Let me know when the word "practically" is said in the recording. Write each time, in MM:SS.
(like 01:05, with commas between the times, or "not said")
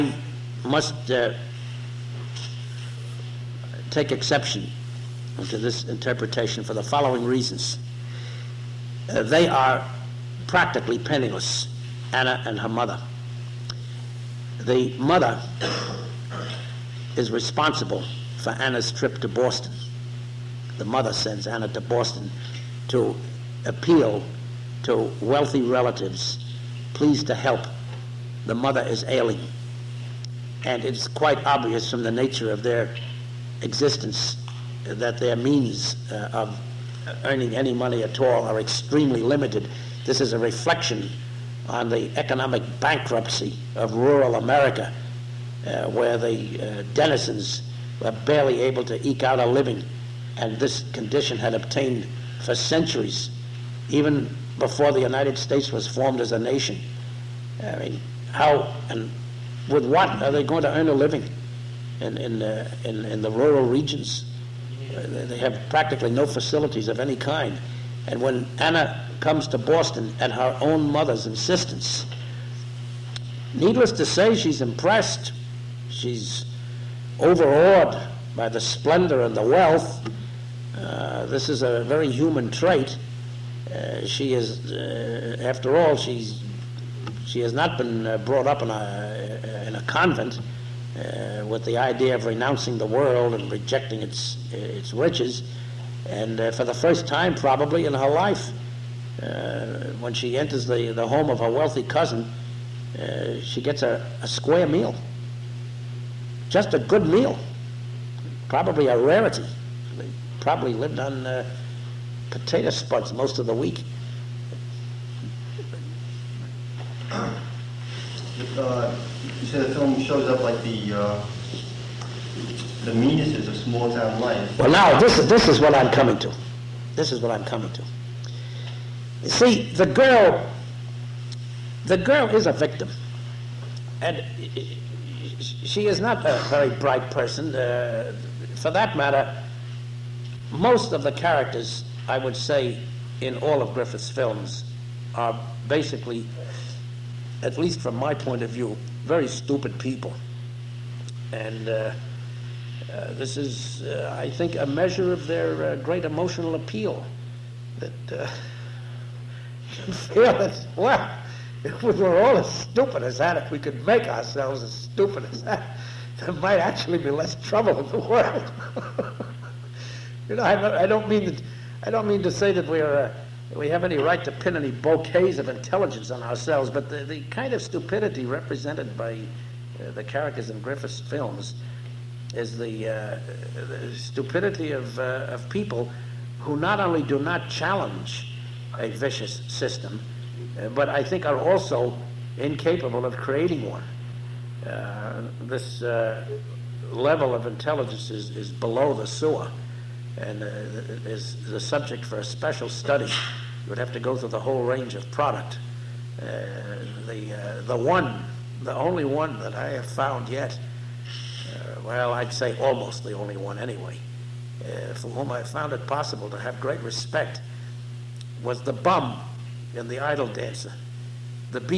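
00:10, 01:05.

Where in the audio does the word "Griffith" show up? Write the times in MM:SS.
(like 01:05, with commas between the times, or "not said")
02:23, 03:00.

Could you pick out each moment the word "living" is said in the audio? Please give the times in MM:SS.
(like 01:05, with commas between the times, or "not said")
00:49, 01:00.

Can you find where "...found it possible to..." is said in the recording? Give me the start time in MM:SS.
03:35.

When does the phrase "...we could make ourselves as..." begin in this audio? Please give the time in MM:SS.
02:43.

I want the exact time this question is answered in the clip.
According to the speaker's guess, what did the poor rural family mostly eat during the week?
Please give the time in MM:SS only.
01:52.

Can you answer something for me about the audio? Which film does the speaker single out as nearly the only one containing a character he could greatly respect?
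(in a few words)
The Idol Dancer.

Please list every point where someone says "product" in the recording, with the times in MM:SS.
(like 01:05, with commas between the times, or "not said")
03:25.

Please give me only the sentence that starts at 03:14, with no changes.
Uh, this uh, level of intelligence is, is below the sewer and is the subject for a special study.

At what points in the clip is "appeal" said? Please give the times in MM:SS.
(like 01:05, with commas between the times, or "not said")
00:23, 02:36.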